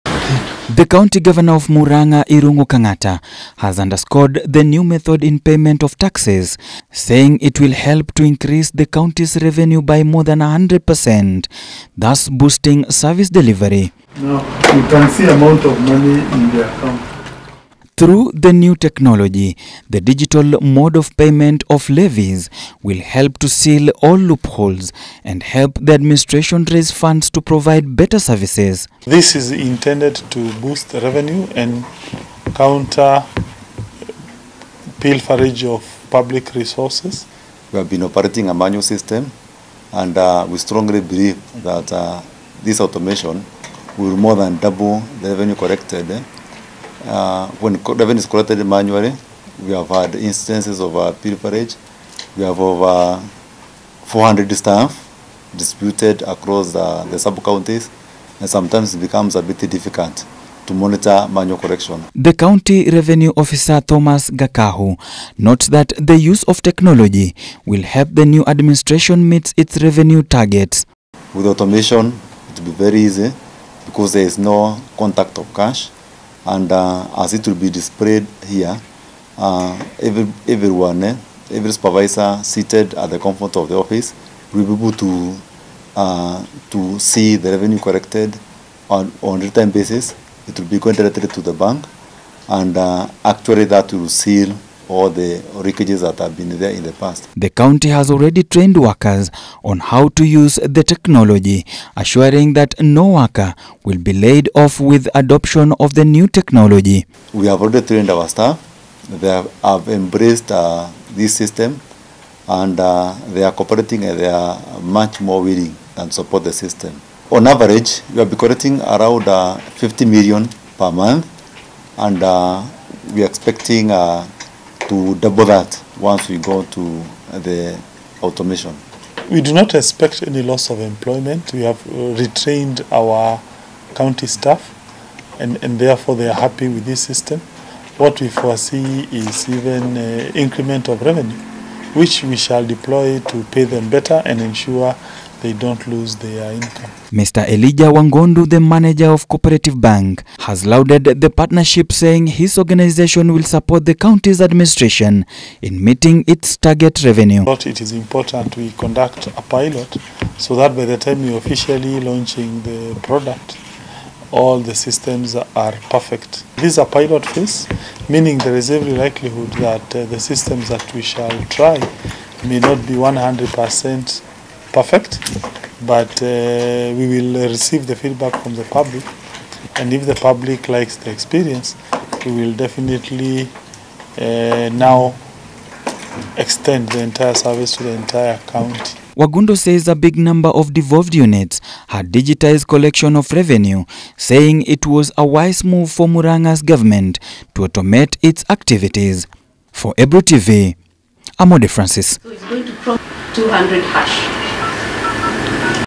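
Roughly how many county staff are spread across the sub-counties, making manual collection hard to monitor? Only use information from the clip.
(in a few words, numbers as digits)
400.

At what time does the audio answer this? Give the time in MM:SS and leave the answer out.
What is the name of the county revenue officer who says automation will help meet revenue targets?
01:03.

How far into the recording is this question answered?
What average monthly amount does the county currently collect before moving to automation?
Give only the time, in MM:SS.
01:59.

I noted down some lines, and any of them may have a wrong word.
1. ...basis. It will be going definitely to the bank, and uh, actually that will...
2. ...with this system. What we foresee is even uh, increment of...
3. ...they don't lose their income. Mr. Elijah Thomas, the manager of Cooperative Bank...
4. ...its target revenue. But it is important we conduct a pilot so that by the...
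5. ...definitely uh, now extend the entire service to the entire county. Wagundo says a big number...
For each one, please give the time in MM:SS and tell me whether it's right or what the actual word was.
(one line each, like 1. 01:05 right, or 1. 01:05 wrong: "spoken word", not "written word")
1. 01:29 wrong: "directly", not "definitely"
2. 02:16 right
3. 02:25 wrong: "Wangondu", not "Thomas"
4. 02:36 right
5. 03:02 right.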